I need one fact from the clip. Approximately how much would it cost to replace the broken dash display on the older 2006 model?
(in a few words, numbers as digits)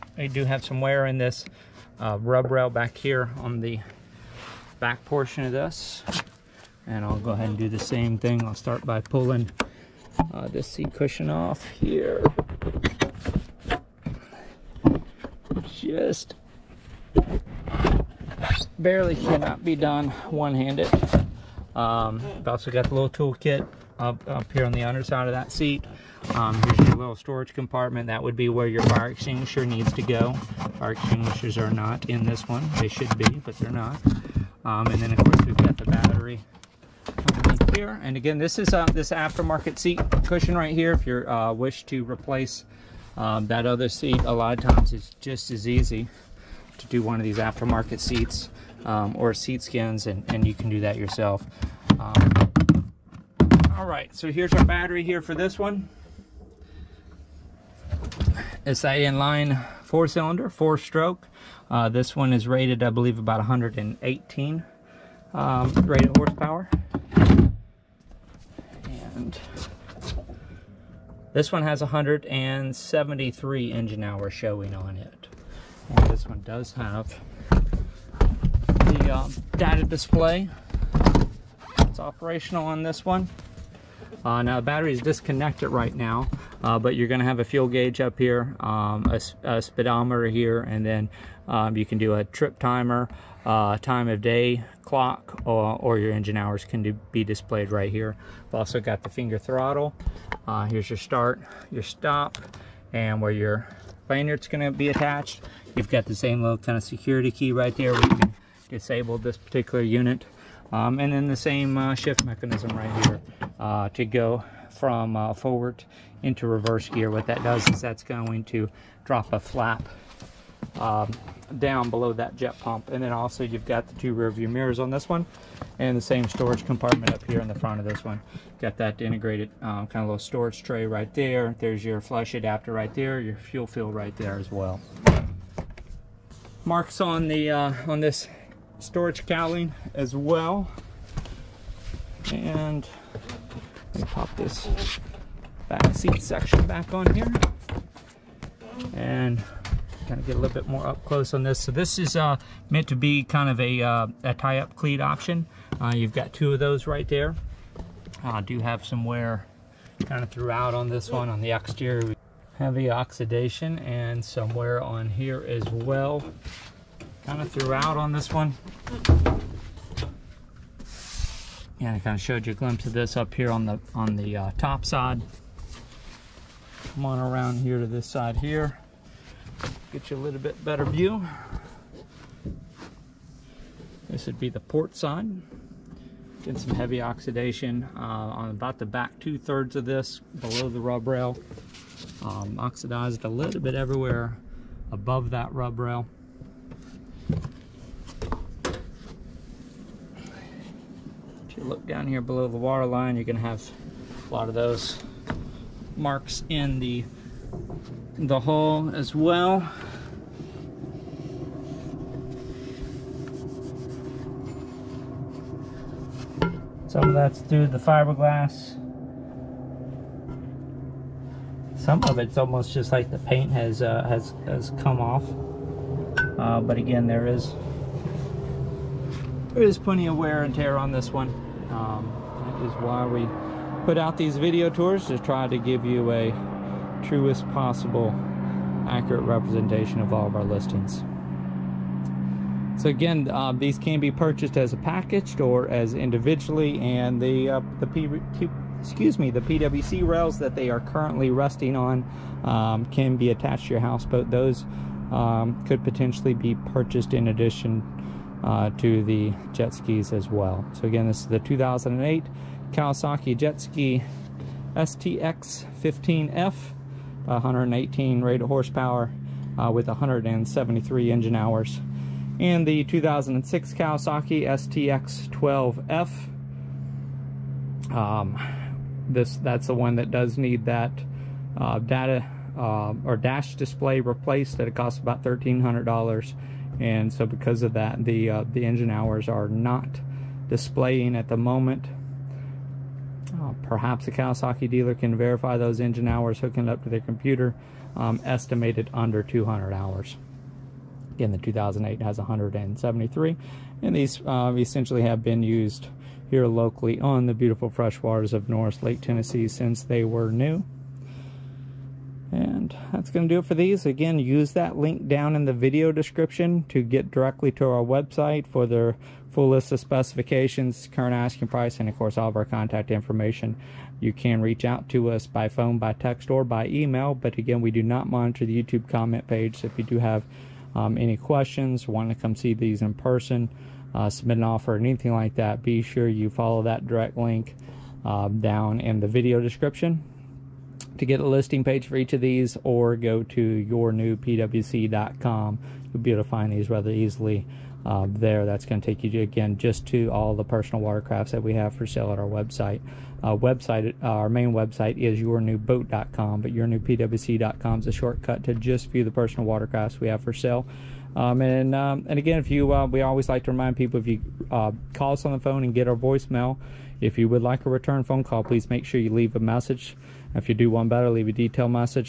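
$1,300.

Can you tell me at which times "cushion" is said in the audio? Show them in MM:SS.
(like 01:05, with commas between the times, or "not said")
00:10, 00:40.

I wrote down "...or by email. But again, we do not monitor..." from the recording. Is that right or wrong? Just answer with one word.
right.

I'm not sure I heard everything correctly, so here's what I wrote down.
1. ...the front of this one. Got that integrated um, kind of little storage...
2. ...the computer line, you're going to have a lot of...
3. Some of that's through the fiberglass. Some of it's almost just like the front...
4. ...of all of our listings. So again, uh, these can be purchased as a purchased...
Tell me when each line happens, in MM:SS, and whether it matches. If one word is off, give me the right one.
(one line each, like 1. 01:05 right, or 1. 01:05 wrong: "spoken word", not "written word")
1. 02:07 right
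2. 03:22 wrong: "water", not "computer"
3. 03:36 wrong: "paint", not "front"
4. 04:00 wrong: "packaged", not "purchased".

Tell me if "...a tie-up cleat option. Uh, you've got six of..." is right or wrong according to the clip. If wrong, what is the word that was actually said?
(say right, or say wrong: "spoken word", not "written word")
wrong: "two", not "six".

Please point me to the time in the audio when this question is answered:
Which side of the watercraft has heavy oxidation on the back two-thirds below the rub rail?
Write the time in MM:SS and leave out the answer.
03:04.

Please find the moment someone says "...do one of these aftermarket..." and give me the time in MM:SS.
00:46.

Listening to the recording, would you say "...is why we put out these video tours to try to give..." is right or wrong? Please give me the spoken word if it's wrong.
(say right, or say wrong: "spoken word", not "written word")
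right.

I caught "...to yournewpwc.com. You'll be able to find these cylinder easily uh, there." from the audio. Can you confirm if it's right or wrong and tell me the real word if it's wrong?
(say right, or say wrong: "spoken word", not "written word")
wrong: "rather", not "cylinder".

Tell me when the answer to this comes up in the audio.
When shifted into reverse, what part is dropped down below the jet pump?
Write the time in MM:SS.
01:59.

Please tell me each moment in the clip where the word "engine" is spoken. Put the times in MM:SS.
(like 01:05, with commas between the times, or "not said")
01:13, 01:36, 04:31, 04:48, 04:55.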